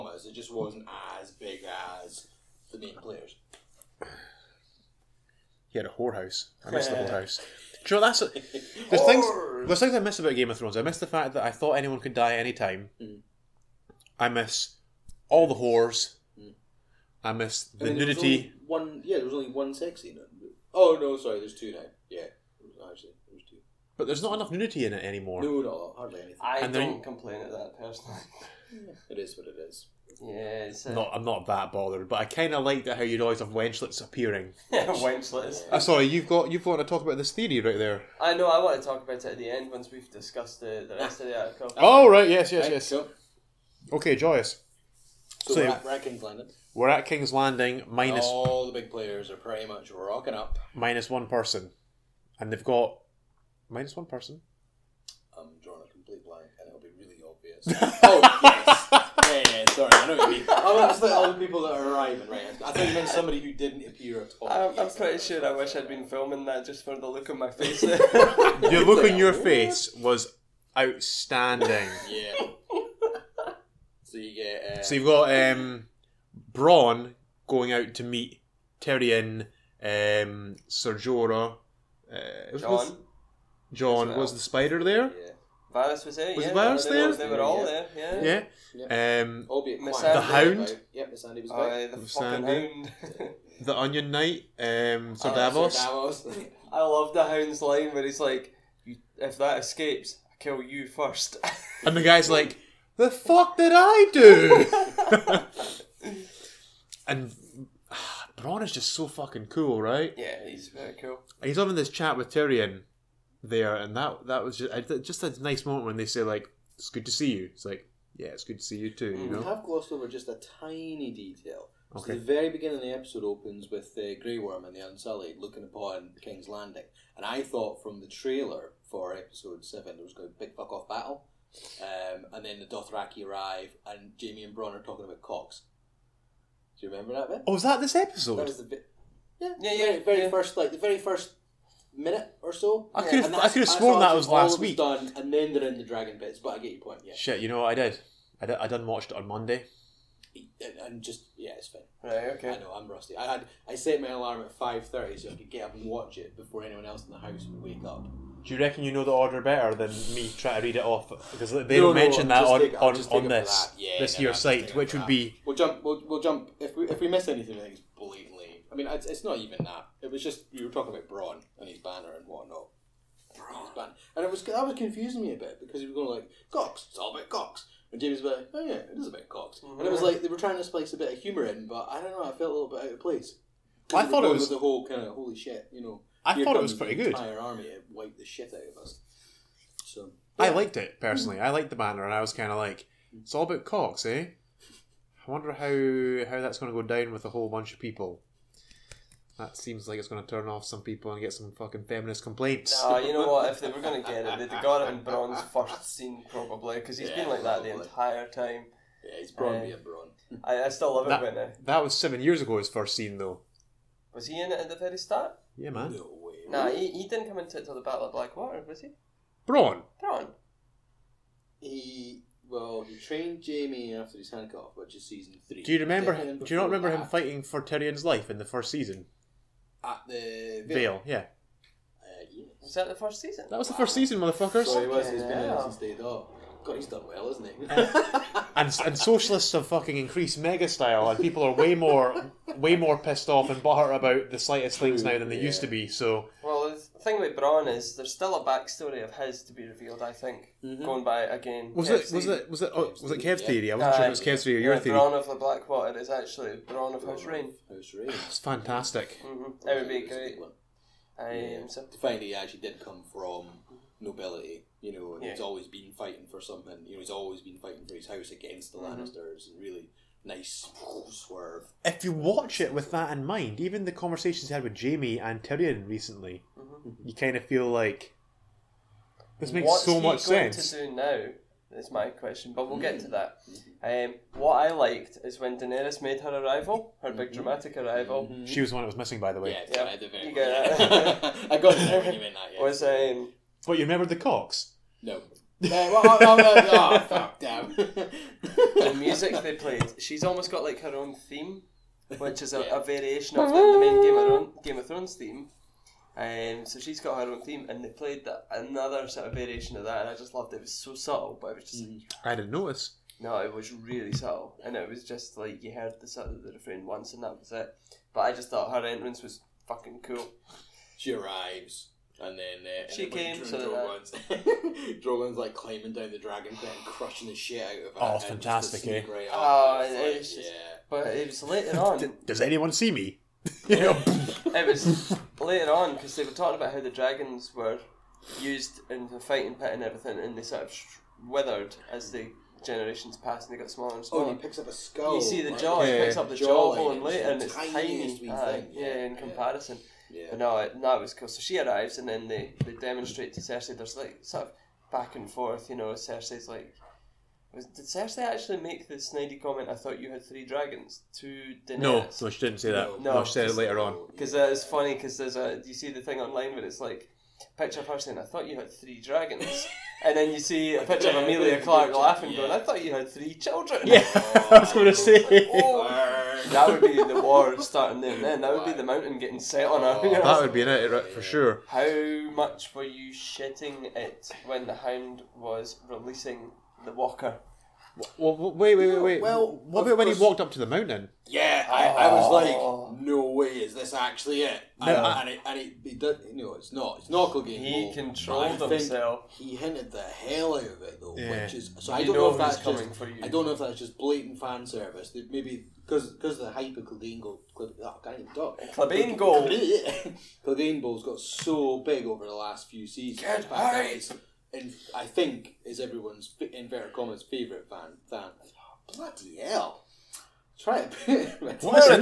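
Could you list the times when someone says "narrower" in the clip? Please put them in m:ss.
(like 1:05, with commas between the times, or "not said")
not said.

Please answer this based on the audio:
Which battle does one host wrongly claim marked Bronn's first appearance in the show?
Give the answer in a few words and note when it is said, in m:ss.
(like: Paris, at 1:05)
Battle of Blackwater, at 3:37.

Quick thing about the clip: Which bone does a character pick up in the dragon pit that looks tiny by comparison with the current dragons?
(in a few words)
The jawbone.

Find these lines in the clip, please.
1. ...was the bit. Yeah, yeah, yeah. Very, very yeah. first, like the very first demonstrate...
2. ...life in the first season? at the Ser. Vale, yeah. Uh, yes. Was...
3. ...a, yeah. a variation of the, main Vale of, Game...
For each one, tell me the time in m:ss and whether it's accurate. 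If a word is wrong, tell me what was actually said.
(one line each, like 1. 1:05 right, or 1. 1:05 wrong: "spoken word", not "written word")
1. 2:18 wrong: "minute", not "demonstrate"
2. 3:48 wrong: "Vale", not "Ser"
3. 5:02 wrong: "Game", not "Vale".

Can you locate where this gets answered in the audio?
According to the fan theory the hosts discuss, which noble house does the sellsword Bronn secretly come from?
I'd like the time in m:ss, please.
4:16.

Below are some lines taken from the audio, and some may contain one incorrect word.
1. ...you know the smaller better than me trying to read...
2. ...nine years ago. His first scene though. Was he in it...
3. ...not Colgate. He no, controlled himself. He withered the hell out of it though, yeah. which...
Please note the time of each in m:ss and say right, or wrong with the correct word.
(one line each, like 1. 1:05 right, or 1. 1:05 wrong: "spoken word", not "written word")
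1. 2:38 wrong: "order", not "smaller"
2. 3:31 wrong: "seven", not "nine"
3. 6:37 wrong: "hinted", not "withered".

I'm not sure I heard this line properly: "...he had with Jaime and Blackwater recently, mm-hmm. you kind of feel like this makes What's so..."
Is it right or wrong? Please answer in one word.
wrong.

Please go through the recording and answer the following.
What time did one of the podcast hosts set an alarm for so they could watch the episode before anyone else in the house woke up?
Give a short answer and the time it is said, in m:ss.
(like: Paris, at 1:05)
5:30, at 2:34.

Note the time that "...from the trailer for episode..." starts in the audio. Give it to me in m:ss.
2:07.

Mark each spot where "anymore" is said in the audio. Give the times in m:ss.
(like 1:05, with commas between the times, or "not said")
0:25.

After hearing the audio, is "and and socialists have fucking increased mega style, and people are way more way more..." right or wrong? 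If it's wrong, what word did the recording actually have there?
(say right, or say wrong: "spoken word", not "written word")
right.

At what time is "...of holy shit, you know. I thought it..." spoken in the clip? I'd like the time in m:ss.
3:05.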